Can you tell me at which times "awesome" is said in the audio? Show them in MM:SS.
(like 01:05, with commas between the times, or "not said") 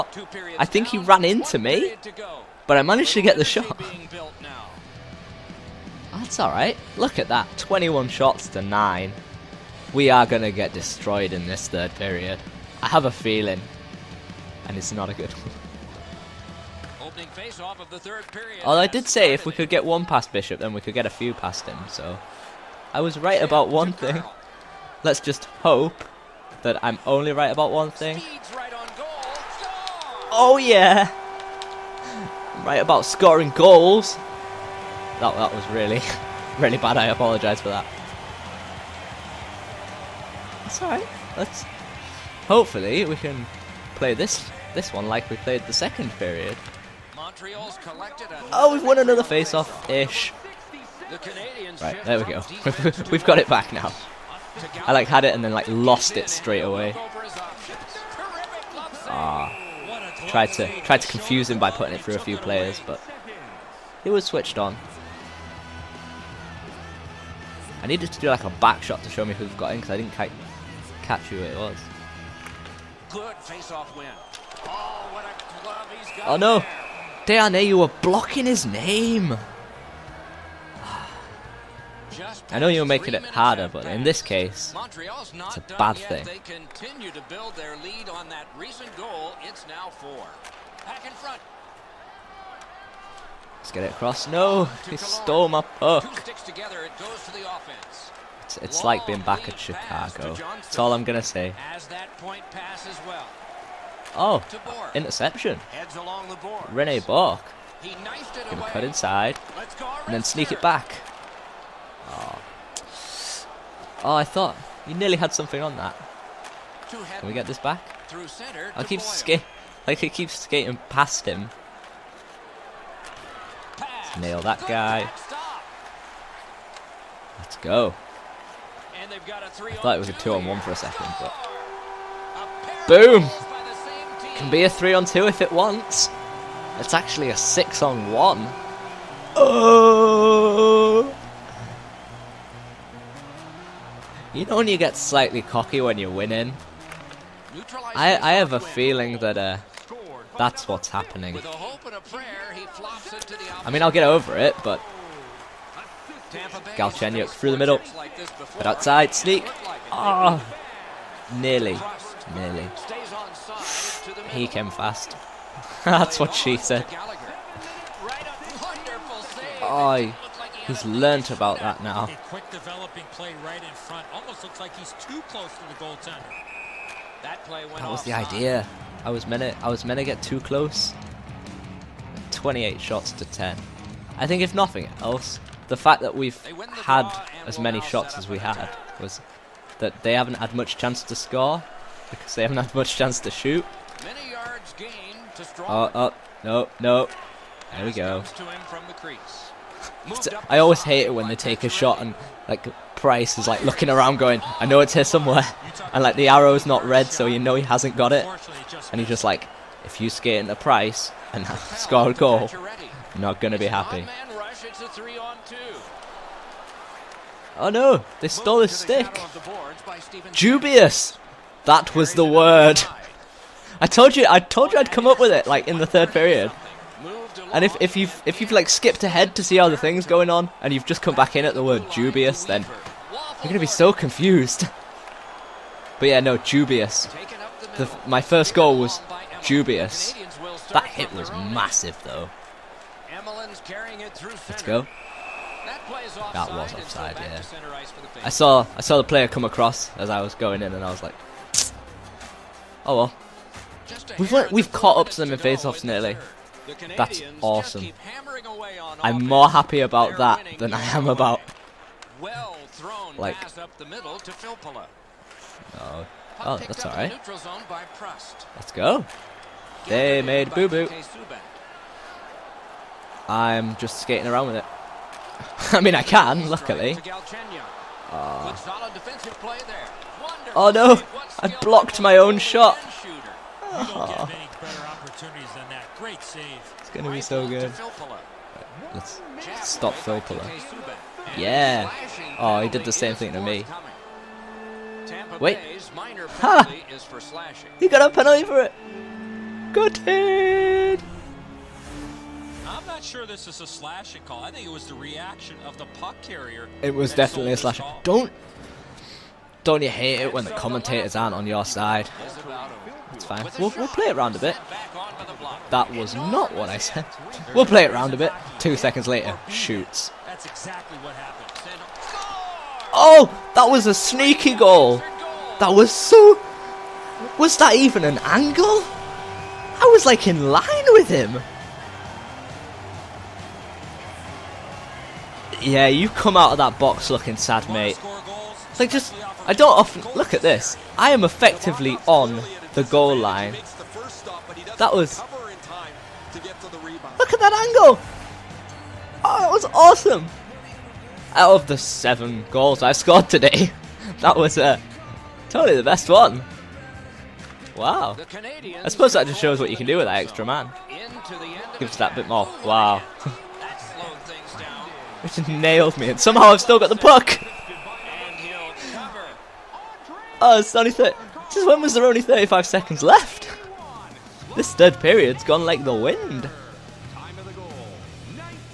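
04:17, 05:49.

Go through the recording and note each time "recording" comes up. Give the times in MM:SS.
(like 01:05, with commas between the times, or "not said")
not said.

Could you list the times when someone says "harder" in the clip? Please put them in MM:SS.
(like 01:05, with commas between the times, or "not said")
01:23.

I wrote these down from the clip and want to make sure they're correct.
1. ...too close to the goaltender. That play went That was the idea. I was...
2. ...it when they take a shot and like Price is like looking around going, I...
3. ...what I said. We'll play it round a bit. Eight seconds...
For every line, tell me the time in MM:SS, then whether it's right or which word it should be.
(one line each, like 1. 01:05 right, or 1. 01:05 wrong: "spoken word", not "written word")
1. 02:54 right
2. 03:21 right
3. 05:16 wrong: "Two", not "Eight".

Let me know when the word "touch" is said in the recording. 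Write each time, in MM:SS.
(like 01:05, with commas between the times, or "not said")
not said.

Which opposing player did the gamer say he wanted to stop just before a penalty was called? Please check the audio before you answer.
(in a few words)
Filppula.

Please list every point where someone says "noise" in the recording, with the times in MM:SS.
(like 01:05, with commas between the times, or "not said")
not said.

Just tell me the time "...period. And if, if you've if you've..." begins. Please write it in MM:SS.
03:46.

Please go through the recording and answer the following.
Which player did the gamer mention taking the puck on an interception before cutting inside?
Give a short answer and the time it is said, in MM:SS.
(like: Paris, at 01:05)
Rene Bourque, at 01:46.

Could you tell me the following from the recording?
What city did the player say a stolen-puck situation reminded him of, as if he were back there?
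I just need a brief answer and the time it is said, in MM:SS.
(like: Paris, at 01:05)
Chicago, at 01:39.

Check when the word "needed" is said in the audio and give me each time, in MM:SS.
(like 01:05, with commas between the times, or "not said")
01:07.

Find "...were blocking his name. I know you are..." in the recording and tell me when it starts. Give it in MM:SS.
01:17.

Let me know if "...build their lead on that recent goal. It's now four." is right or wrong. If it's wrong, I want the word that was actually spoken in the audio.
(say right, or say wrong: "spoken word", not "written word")
right.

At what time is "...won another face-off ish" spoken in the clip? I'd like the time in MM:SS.
00:48.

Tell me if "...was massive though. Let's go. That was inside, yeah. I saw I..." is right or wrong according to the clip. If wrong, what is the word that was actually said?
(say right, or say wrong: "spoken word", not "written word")
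wrong: "offside", not "inside".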